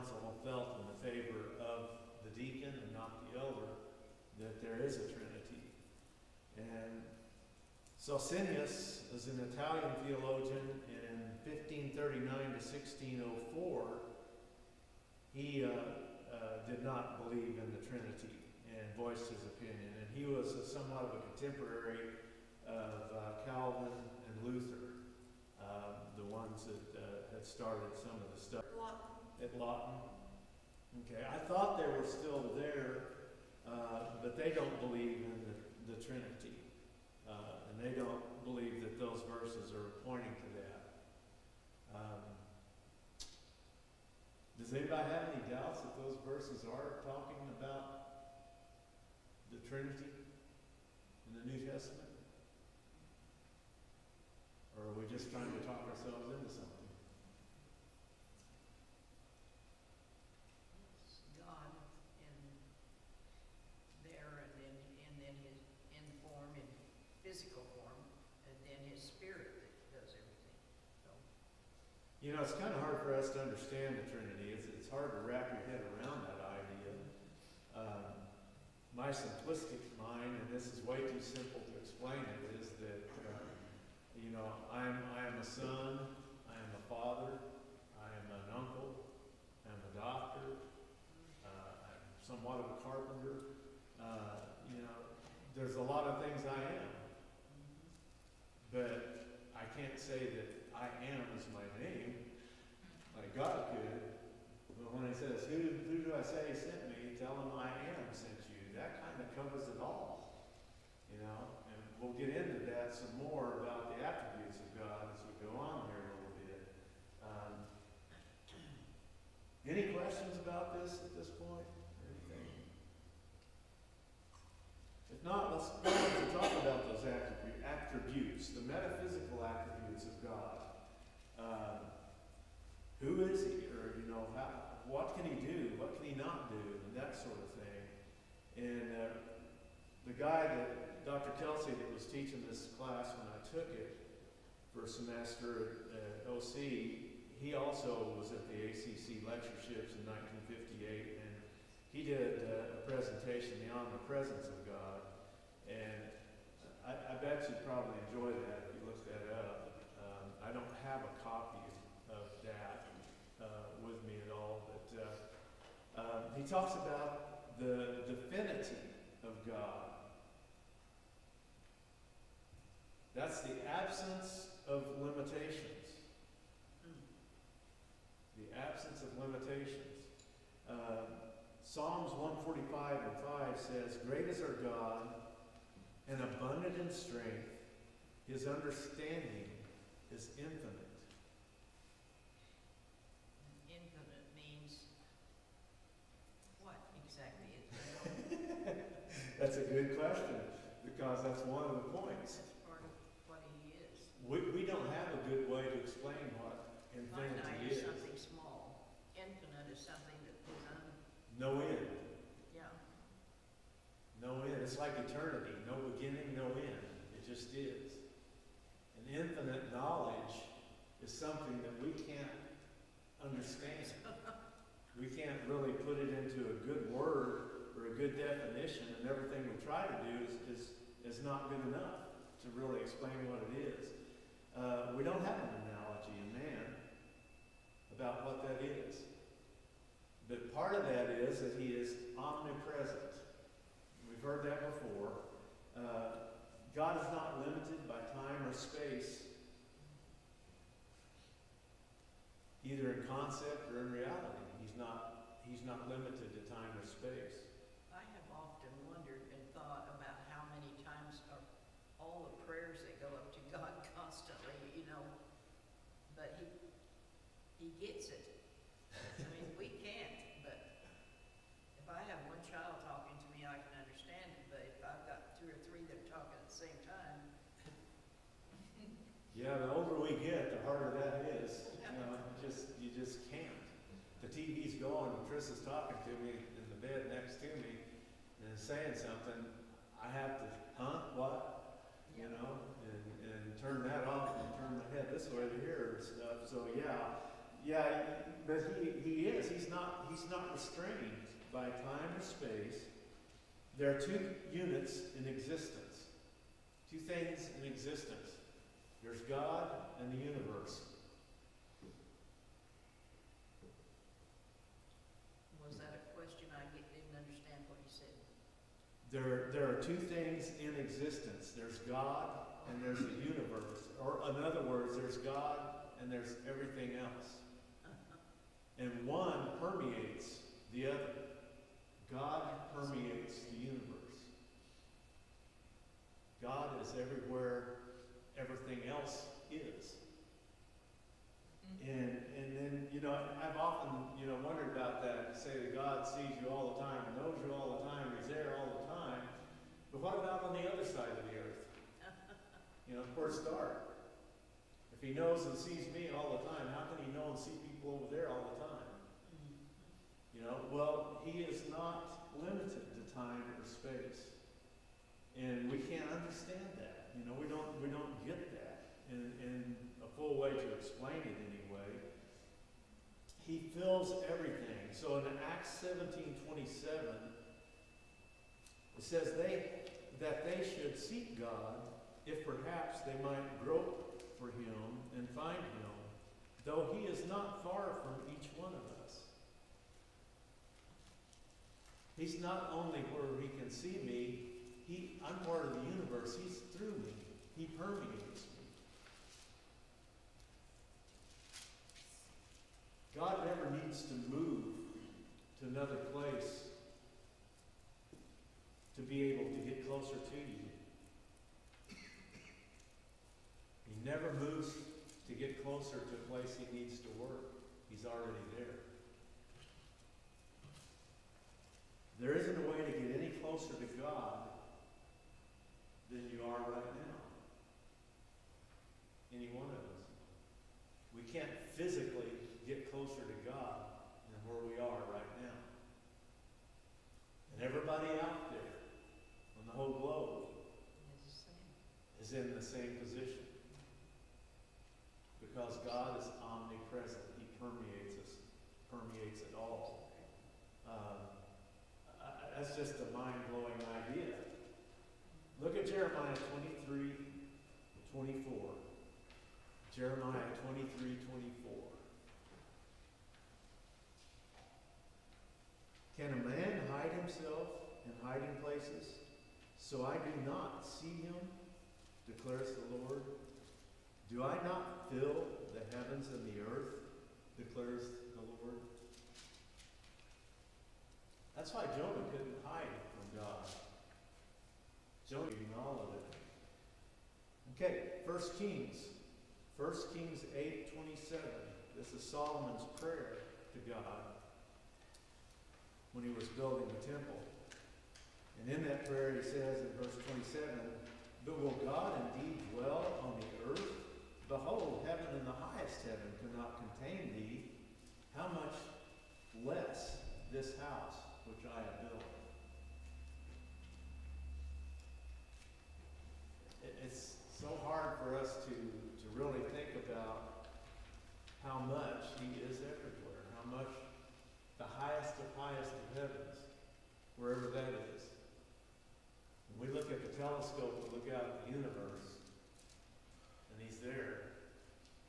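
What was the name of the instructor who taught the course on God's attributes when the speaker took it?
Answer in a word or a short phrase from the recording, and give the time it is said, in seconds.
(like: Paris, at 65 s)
Dr. Kelsey, at 141 s.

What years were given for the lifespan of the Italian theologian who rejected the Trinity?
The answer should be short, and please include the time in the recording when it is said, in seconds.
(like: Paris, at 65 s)
1539 to 1604, at 11 s.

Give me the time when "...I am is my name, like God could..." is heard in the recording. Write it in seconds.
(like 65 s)
100 s.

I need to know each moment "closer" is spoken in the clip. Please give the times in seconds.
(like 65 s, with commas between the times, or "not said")
409 s, 415 s, 423 s.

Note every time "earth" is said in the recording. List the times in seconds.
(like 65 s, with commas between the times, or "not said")
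351 s, 476 s, 503 s.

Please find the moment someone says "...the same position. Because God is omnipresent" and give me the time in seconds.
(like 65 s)
442 s.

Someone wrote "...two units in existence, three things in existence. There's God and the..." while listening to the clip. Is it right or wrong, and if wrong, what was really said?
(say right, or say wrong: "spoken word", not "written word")
wrong: "two", not "three".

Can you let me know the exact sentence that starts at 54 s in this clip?
Or are we just trying to talk ourselves into something?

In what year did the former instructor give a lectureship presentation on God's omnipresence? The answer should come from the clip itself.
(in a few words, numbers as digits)
1958.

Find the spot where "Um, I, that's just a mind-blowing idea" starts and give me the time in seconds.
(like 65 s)
450 s.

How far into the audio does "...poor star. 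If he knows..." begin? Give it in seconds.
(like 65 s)
353 s.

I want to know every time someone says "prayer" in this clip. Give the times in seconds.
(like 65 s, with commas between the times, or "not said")
492 s, 499 s.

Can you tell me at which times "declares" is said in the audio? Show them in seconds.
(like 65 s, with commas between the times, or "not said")
472 s, 477 s.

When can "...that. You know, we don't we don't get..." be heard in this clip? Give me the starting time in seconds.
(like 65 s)
366 s.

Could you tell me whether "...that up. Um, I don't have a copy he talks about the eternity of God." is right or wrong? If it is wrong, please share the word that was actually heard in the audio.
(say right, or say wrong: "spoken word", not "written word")
wrong: "divinity", not "eternity".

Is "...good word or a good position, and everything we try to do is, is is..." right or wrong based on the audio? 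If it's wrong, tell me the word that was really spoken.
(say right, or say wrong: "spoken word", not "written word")
wrong: "definition", not "position".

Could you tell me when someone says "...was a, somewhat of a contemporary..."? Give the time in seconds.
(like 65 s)
20 s.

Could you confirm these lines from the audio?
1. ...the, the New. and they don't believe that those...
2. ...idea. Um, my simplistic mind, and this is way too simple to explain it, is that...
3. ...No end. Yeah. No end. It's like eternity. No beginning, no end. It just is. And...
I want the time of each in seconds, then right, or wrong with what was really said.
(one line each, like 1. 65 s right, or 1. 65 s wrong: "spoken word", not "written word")
1. 35 s wrong: "Trinity", not "New"
2. 76 s right
3. 211 s right.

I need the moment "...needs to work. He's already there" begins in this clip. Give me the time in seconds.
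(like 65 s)
416 s.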